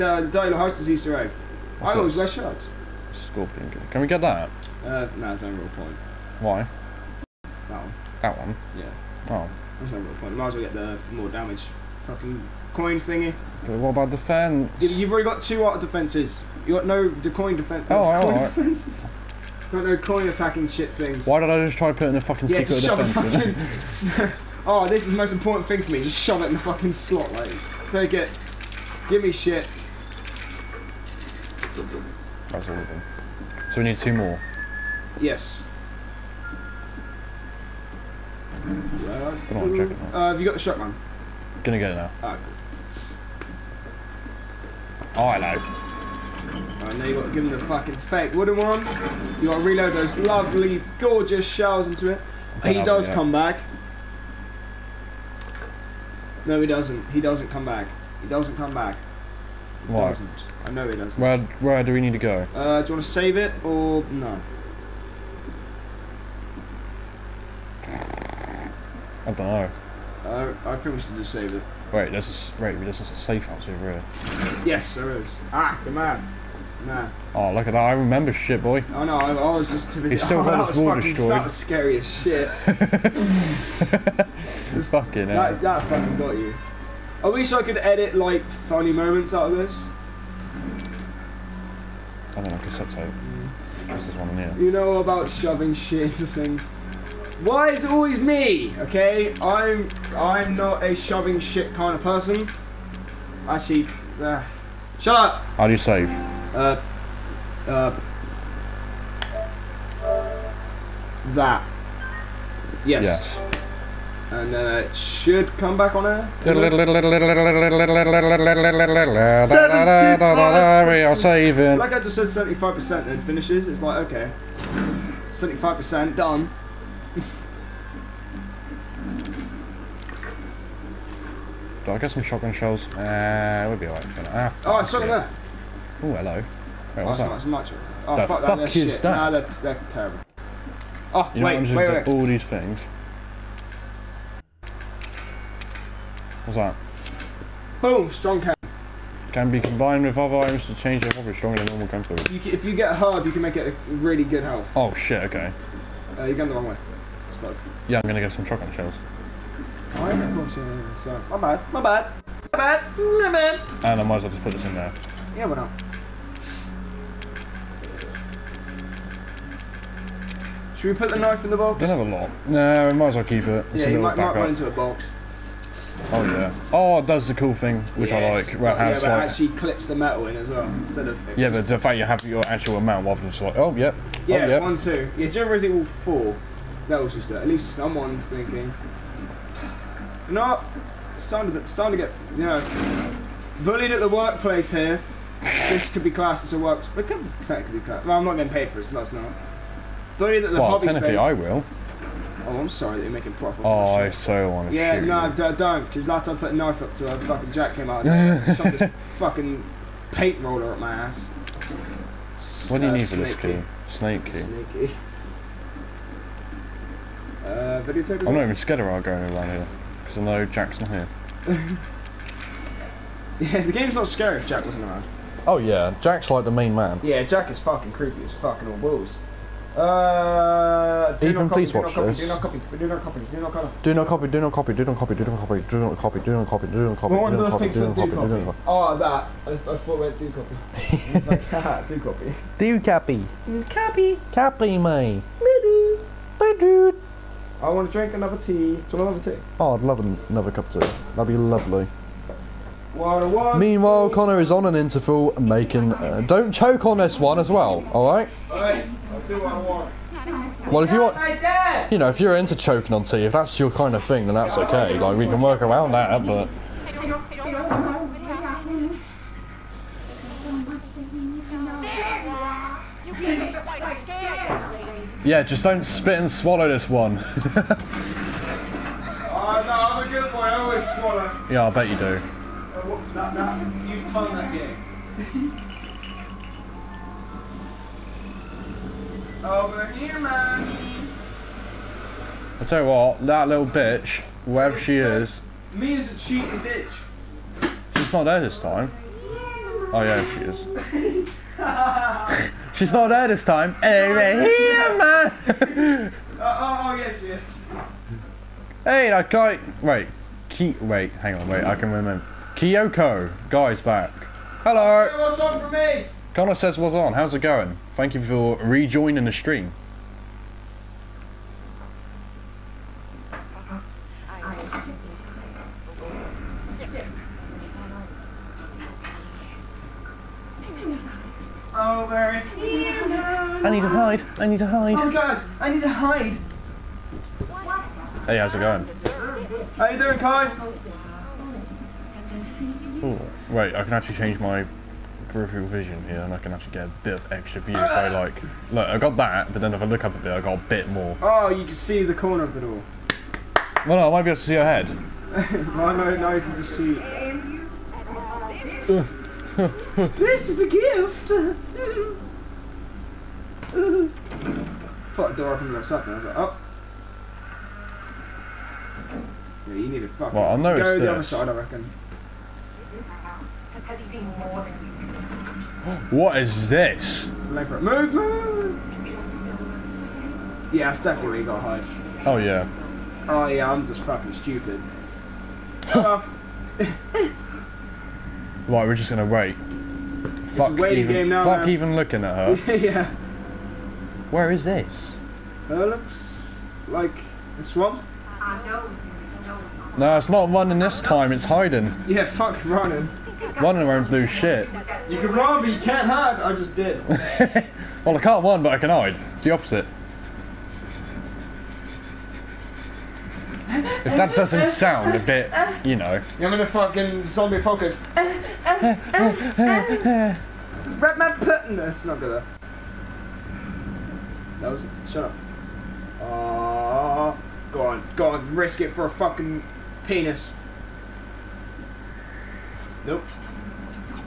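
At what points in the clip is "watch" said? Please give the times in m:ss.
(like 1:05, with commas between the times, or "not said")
3:51.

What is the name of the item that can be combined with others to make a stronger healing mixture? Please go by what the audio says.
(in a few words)
Strong chem.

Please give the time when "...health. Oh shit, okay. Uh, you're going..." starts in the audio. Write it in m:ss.
2:34.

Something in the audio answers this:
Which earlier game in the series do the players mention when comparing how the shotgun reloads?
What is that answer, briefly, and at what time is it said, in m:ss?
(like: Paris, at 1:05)
Resident Evil four, at 3:05.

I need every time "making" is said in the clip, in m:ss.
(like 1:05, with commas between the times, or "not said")
3:23, 4:15.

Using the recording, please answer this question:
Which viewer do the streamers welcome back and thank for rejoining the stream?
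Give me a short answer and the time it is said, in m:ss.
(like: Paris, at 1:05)
Kyoko, at 5:12.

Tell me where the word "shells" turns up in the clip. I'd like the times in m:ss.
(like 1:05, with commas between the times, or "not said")
0:51, 2:12, 2:38.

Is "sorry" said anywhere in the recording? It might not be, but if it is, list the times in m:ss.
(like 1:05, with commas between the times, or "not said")
3:22.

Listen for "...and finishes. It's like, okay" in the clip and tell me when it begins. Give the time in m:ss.
2:03.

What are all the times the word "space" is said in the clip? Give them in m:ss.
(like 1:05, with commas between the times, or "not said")
3:21.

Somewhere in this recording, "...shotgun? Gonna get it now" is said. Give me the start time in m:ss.
0:40.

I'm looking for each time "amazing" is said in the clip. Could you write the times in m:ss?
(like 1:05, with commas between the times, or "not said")
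not said.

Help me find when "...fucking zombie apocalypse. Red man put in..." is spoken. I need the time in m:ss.
6:56.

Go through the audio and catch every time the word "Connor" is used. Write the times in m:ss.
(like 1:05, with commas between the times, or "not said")
4:14, 5:16.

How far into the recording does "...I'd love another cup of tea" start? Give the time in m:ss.
4:09.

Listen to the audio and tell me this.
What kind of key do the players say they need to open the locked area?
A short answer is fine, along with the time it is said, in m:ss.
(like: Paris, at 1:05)
Snake key, at 3:33.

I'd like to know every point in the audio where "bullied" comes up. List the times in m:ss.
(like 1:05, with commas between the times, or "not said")
3:13.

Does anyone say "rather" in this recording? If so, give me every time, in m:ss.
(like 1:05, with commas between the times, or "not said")
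3:03.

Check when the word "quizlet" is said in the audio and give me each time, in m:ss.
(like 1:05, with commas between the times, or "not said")
not said.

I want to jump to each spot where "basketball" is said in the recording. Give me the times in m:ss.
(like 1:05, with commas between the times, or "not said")
not said.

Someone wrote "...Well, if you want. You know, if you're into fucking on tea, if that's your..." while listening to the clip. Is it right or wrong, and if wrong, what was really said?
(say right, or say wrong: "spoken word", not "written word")
wrong: "choking", not "fucking".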